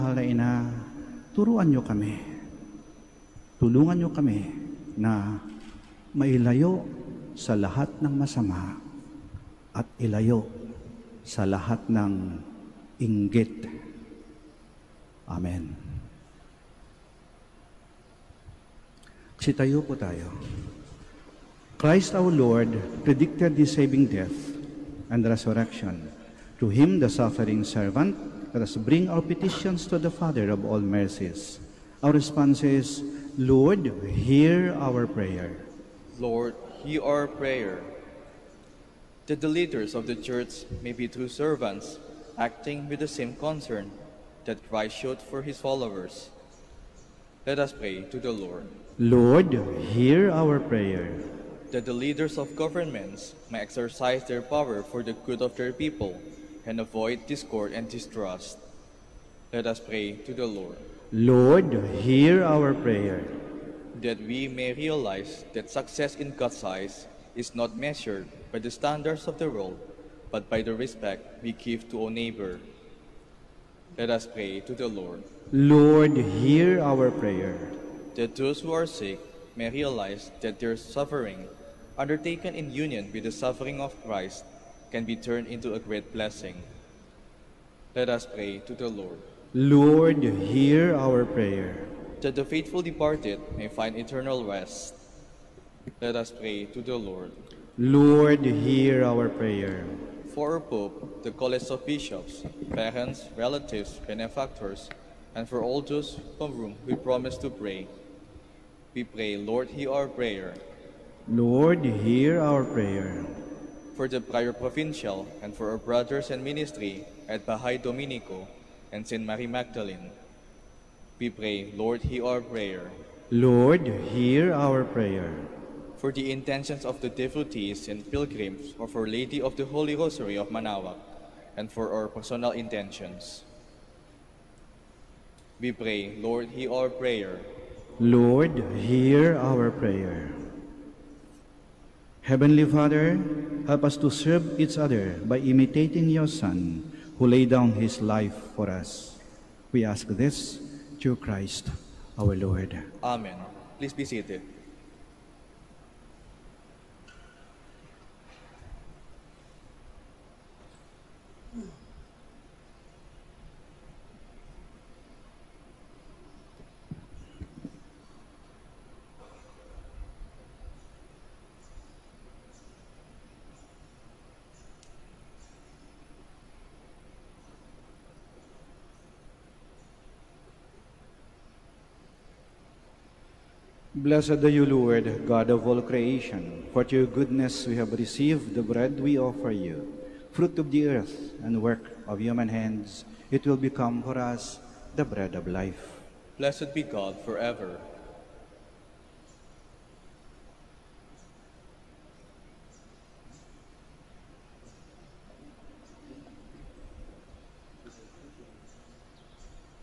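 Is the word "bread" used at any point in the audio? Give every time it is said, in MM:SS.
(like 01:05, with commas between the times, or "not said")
03:08, 03:15.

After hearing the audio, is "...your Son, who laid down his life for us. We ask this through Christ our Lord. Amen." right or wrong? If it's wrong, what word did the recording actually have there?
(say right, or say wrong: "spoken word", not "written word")
right.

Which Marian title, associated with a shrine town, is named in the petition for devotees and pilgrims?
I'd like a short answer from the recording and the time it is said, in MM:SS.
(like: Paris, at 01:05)
Our Lady of the Holy Rosary of Manaoag, at 02:08.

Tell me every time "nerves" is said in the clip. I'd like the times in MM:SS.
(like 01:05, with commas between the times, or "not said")
not said.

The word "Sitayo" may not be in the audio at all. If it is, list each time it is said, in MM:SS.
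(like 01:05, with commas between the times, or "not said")
00:19.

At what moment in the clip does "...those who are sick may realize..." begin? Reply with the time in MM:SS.
01:18.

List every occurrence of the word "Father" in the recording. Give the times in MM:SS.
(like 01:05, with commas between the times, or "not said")
00:30, 02:22.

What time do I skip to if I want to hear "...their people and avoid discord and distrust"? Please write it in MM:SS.
00:55.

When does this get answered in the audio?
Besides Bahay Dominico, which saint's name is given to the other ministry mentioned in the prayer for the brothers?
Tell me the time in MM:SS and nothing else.
01:59.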